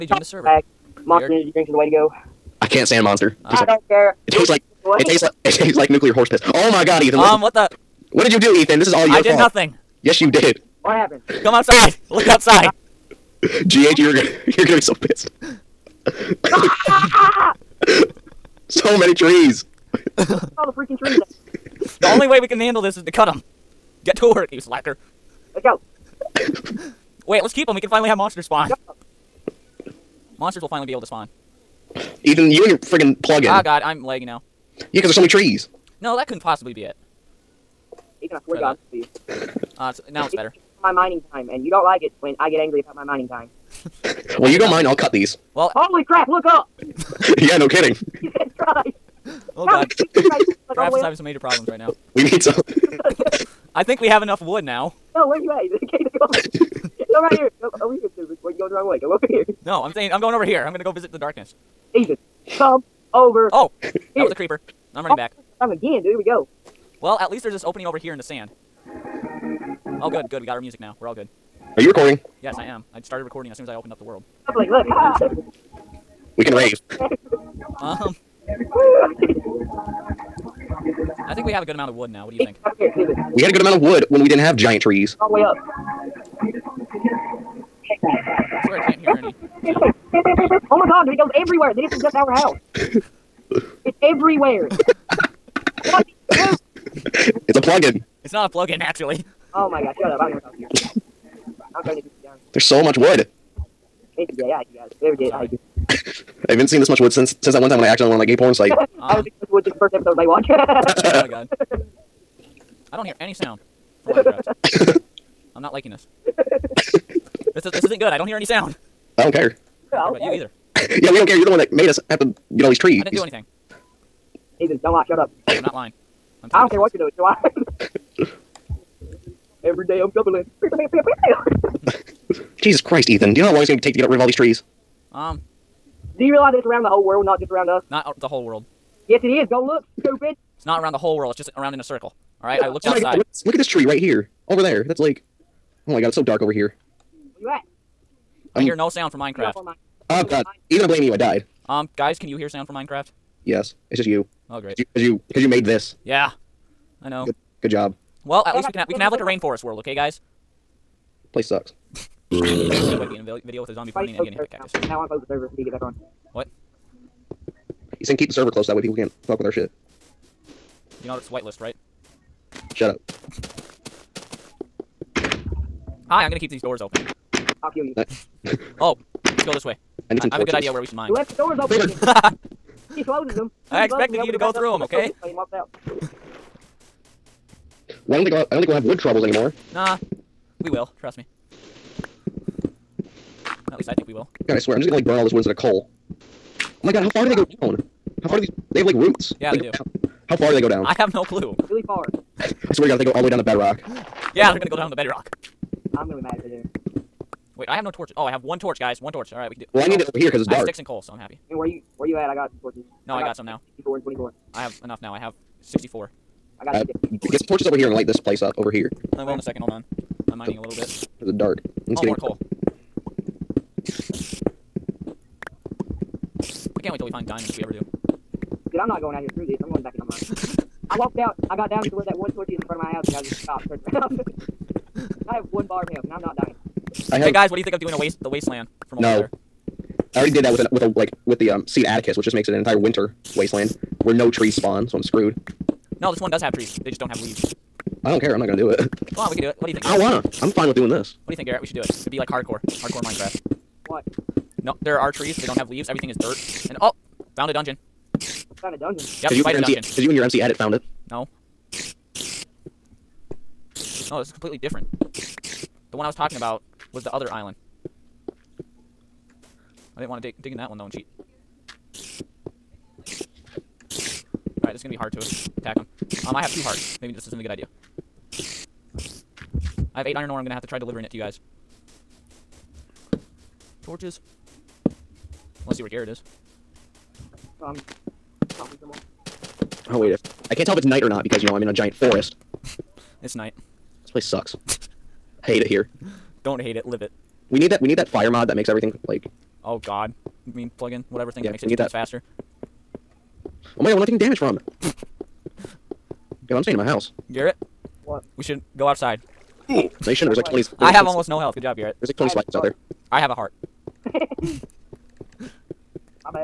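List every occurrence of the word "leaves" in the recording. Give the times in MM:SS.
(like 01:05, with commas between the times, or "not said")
04:07, 04:15.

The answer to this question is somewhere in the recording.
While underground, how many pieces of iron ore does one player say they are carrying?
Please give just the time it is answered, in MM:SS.
04:40.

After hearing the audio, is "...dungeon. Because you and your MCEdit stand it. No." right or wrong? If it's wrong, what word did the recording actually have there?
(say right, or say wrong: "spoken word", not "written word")
wrong: "found", not "stand".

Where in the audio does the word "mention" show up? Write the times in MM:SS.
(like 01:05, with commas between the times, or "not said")
not said.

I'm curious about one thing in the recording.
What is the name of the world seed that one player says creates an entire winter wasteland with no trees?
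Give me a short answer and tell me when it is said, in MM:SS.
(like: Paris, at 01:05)
Atticus, at 04:01.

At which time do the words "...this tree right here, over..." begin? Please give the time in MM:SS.
02:23.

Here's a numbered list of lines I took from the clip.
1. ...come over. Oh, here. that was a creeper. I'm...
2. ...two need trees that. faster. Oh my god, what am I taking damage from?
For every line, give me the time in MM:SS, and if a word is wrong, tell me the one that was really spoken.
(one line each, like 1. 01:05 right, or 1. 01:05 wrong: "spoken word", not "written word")
1. 01:02 right
2. 05:01 wrong: "times", not "trees".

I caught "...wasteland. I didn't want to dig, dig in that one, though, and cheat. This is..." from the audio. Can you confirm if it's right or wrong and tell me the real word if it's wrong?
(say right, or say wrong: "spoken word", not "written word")
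wrong: "island", not "wasteland".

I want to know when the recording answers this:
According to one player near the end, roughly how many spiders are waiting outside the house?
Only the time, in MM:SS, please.
05:12.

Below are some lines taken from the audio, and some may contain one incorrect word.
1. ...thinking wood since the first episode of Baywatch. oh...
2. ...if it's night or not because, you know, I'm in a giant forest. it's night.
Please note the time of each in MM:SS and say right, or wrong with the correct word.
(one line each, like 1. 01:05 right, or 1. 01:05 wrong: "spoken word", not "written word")
1. 01:49 right
2. 04:50 right.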